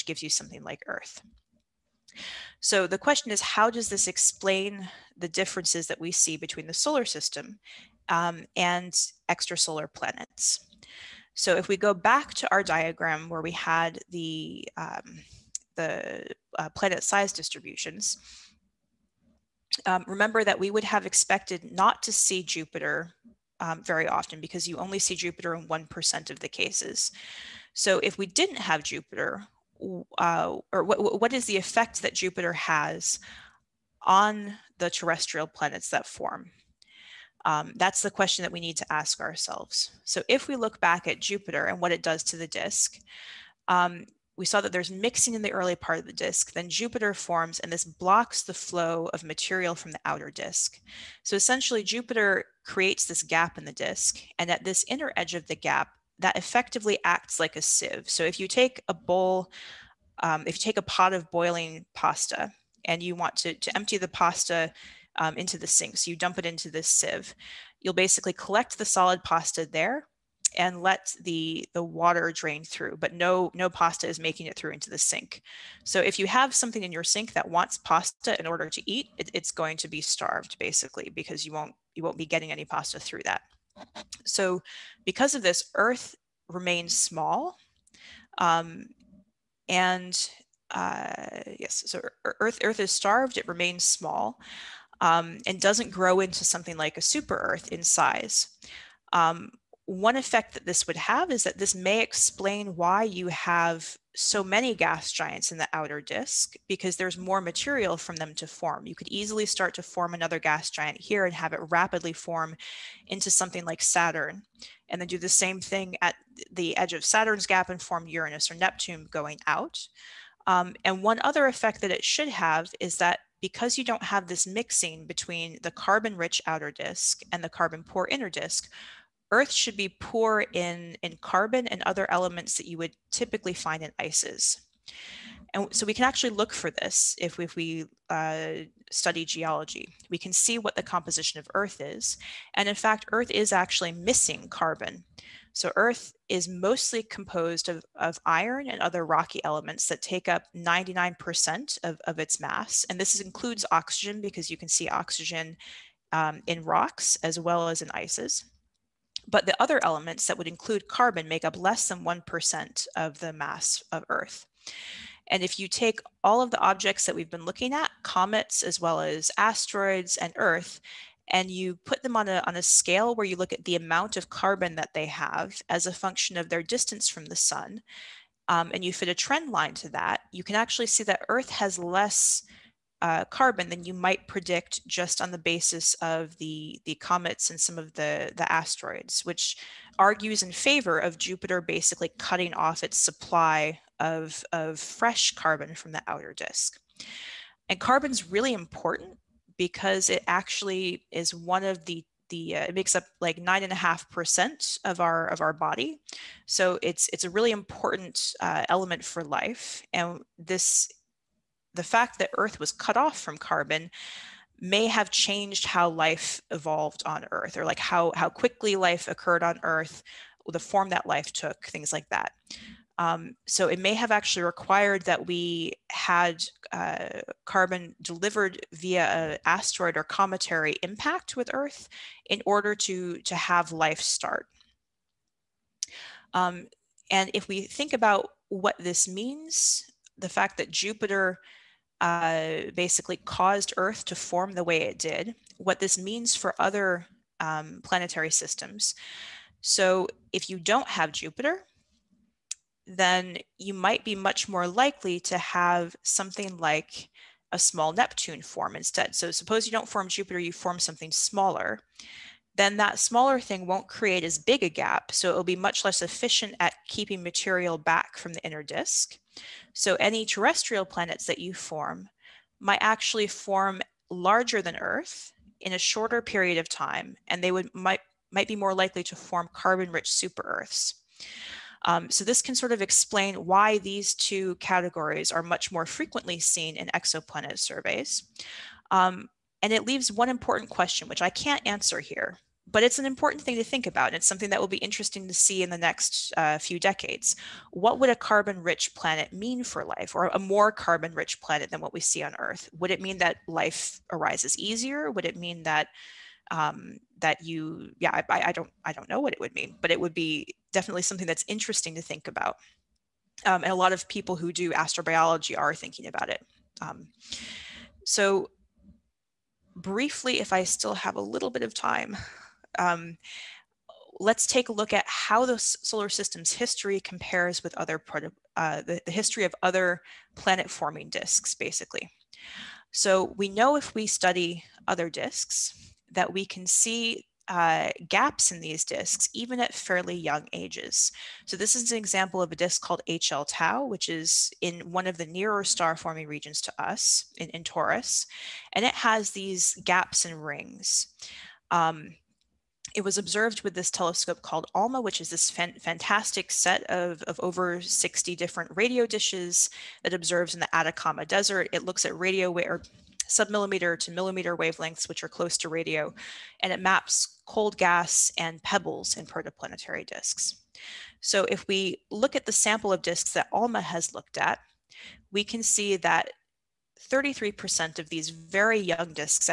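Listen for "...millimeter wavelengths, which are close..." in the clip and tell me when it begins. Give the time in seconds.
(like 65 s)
364 s.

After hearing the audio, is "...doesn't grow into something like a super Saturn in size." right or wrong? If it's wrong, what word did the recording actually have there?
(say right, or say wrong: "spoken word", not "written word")
wrong: "Earth", not "Saturn".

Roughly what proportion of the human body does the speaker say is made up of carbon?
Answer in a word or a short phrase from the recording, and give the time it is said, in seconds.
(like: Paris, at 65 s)
9.5%, at 203 s.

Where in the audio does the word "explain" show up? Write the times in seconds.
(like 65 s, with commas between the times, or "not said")
4 s, 102 s, 282 s.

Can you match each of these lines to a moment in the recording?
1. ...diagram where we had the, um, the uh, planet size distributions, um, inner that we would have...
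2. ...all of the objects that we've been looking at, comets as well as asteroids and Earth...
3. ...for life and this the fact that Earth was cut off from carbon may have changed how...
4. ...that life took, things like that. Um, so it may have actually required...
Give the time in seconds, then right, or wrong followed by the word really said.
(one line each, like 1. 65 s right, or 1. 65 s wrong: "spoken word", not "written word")
1. 12 s wrong: "remember", not "inner"
2. 166 s right
3. 209 s right
4. 220 s right.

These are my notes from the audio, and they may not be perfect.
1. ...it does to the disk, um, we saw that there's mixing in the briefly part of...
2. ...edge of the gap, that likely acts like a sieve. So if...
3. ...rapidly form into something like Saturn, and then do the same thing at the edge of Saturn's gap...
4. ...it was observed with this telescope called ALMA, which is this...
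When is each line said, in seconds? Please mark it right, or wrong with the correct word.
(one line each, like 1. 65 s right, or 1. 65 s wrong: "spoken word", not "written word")
1. 41 s wrong: "early", not "briefly"
2. 55 s wrong: "effectively", not "likely"
3. 111 s right
4. 352 s right.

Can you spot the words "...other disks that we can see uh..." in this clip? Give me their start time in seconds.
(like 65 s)
334 s.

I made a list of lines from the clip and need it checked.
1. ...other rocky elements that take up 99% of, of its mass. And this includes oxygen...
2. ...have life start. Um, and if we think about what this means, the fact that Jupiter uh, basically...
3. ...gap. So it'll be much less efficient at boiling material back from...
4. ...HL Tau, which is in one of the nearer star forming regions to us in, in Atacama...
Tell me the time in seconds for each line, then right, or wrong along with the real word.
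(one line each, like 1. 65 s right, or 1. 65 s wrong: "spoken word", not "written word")
1. 148 s right
2. 233 s right
3. 264 s wrong: "keeping", not "boiling"
4. 343 s wrong: "Taurus", not "Atacama".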